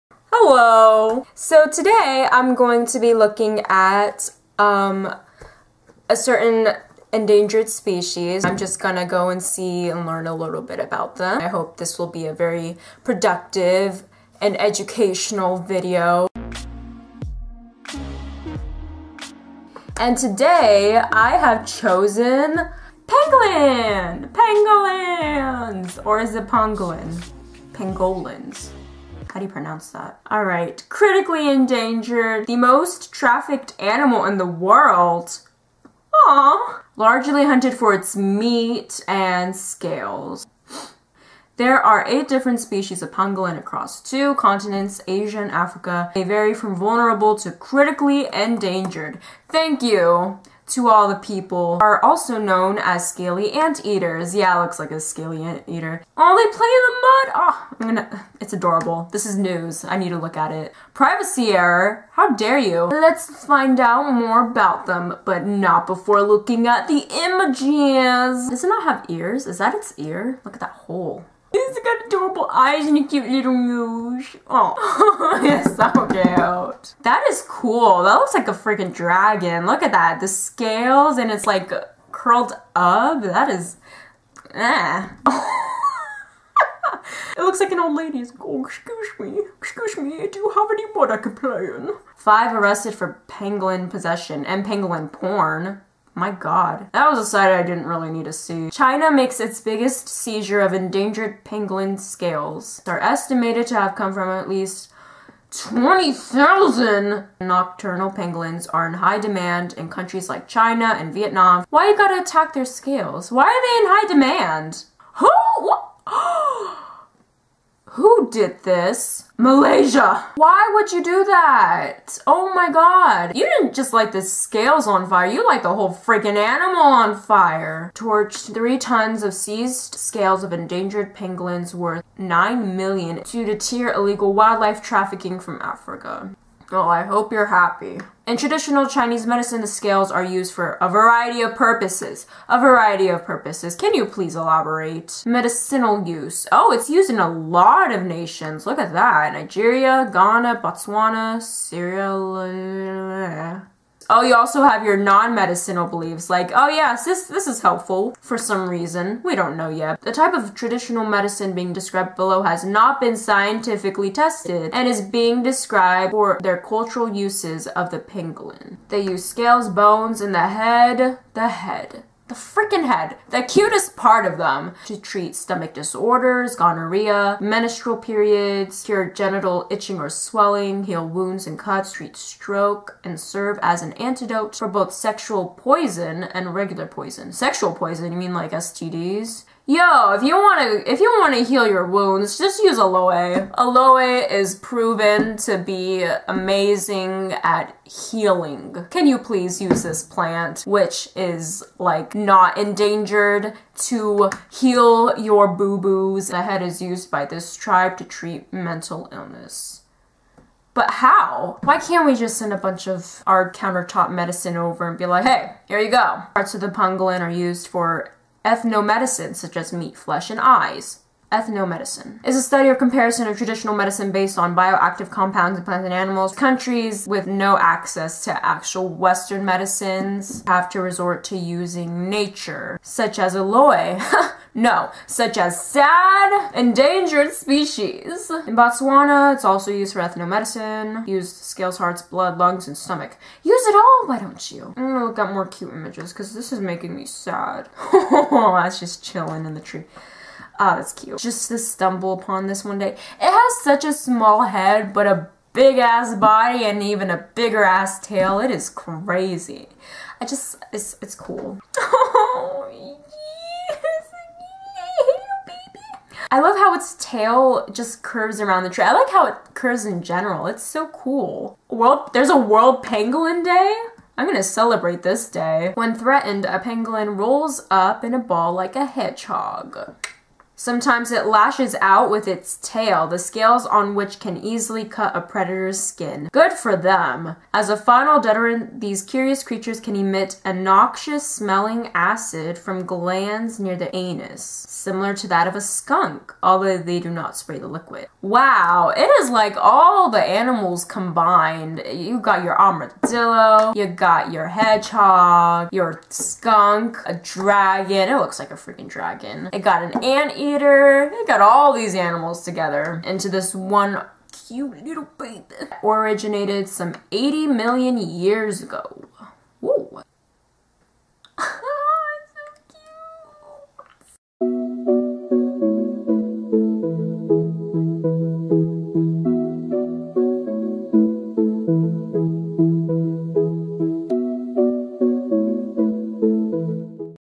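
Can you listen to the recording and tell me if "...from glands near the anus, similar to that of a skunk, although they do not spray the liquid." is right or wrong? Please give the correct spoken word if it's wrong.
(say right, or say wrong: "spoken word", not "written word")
right.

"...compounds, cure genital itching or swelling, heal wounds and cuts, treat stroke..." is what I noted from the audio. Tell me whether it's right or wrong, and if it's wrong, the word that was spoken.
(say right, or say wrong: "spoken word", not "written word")
wrong: "periods", not "compounds".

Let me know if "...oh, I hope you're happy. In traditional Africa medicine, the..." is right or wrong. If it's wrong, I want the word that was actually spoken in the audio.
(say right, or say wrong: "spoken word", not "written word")
wrong: "Chinese", not "Africa".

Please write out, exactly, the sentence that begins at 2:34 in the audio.
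Oh, you also have your non-medicinal beliefs, like, oh yes, this, this is helpful for some reason.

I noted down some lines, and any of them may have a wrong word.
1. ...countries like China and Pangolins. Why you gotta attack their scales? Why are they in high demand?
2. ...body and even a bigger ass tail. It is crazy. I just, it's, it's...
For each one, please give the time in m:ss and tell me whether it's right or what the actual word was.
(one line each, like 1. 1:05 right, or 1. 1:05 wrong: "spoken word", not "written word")
1. 1:49 wrong: "Vietnam", not "Pangolins"
2. 4:16 right.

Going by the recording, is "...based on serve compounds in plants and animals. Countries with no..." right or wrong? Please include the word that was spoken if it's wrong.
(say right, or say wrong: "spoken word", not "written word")
wrong: "bioactive", not "serve".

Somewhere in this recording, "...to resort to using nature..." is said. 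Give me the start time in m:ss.
3:50.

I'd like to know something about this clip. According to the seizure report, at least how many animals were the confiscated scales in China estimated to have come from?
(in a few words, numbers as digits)
20,000.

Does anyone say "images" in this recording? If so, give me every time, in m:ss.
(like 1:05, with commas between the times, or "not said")
1:07, 4:05.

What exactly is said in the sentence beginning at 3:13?
Aloe is proven to be amazing at healing.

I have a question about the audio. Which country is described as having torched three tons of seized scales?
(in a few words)
Malaysia.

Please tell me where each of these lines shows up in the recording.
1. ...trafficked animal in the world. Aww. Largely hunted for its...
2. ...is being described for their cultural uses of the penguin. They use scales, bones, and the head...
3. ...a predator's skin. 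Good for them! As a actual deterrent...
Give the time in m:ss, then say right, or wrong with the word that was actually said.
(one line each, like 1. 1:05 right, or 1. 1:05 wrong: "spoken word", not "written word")
1. 0:33 right
2. 2:44 wrong: "pangolin", not "penguin"
3. 4:45 wrong: "final", not "actual".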